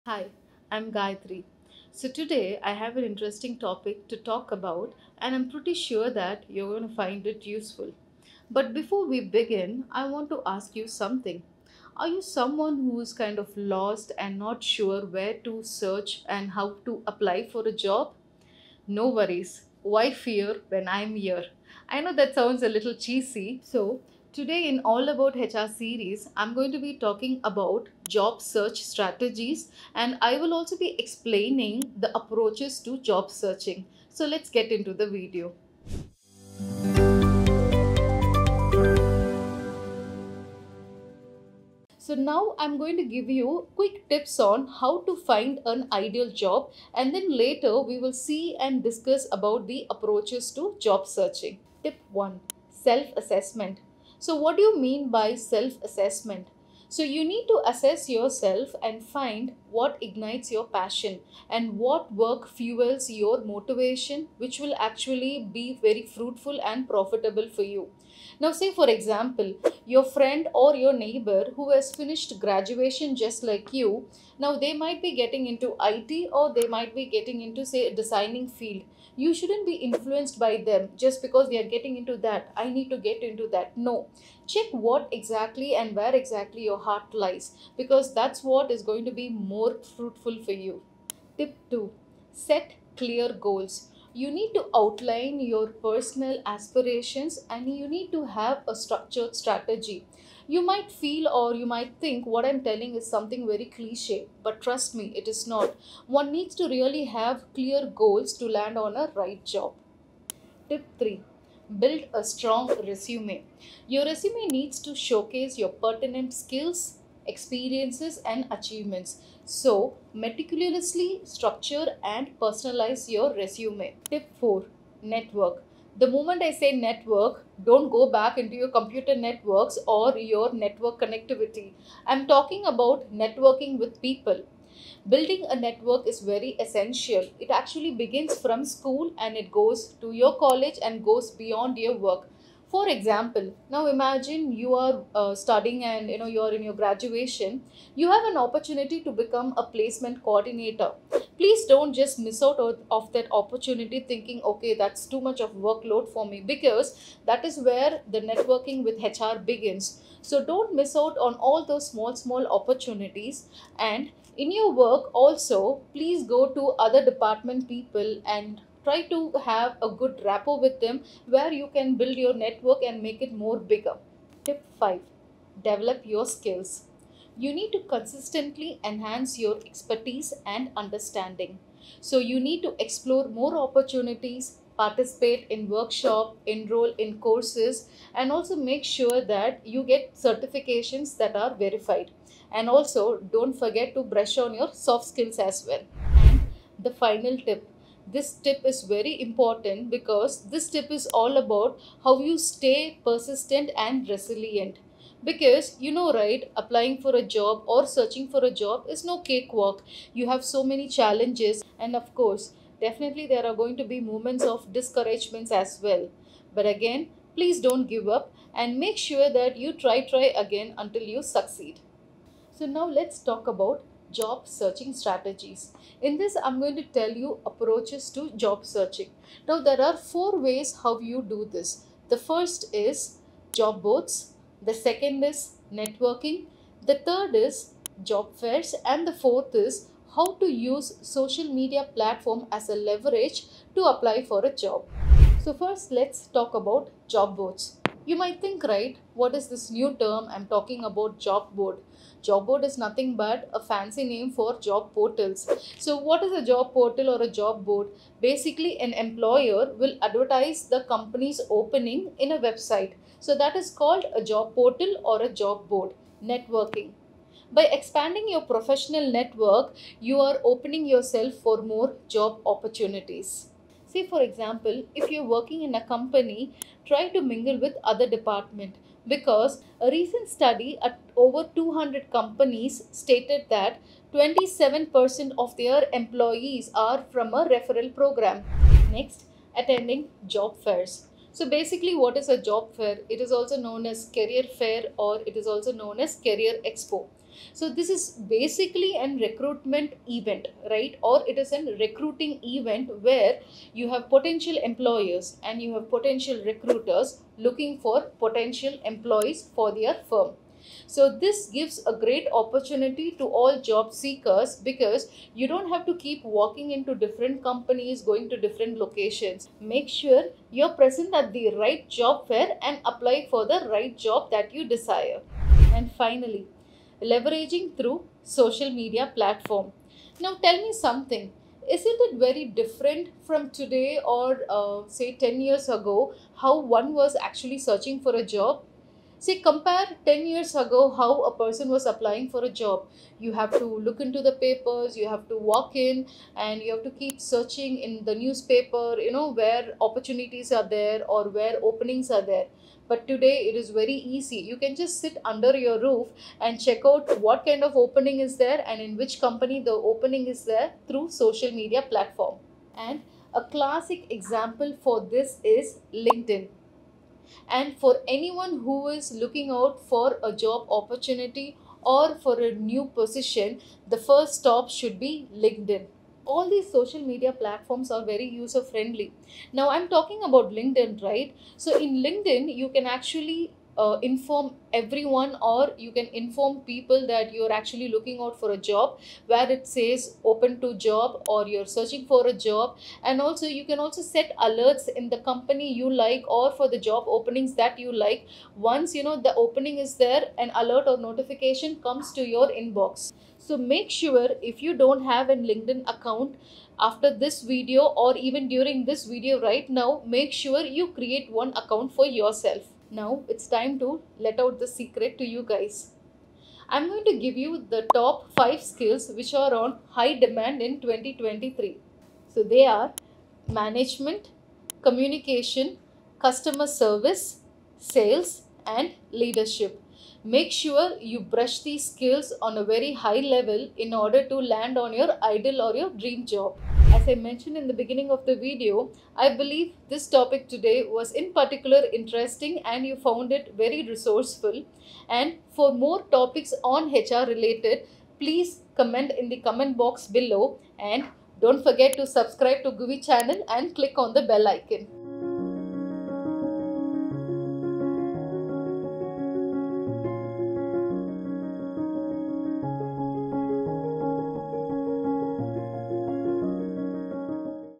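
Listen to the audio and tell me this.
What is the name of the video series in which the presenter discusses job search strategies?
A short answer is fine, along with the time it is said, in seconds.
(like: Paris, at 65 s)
All About HR, at 24 s.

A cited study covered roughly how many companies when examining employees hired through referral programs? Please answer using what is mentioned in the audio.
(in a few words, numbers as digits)
200.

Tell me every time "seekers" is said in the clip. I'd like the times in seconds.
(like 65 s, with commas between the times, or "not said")
313 s.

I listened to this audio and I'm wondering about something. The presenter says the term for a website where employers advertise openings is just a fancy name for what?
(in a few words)
Job portals.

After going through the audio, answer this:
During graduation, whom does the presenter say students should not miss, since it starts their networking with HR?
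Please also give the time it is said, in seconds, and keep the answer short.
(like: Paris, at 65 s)
Placement coordinator, at 149 s.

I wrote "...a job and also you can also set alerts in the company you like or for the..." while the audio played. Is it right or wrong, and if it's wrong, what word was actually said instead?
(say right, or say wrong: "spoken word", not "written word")
right.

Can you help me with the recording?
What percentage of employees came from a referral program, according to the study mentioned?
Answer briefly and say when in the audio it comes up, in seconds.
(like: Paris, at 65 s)
27%, at 284 s.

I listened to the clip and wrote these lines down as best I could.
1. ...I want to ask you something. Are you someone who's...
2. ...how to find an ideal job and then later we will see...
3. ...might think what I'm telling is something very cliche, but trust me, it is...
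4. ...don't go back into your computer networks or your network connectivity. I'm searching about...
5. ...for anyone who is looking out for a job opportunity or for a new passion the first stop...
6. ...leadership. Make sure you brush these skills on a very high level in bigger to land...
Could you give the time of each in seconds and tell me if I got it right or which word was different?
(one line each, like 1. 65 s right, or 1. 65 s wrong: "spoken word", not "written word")
1. 9 s right
2. 44 s right
3. 101 s right
4. 127 s wrong: "talking", not "searching"
5. 367 s wrong: "position", not "passion"
6. 429 s wrong: "order", not "bigger".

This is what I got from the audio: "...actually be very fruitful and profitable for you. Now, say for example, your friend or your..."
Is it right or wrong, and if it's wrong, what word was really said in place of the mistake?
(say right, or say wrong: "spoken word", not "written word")
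right.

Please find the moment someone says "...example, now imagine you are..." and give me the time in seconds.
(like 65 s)
142 s.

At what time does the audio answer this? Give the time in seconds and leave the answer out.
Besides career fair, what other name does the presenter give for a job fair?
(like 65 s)
296 s.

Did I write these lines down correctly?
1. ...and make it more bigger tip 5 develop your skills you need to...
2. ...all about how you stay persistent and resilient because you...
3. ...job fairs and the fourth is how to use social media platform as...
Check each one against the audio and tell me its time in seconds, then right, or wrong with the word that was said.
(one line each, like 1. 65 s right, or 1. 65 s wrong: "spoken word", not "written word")
1. 172 s right
2. 201 s right
3. 238 s right.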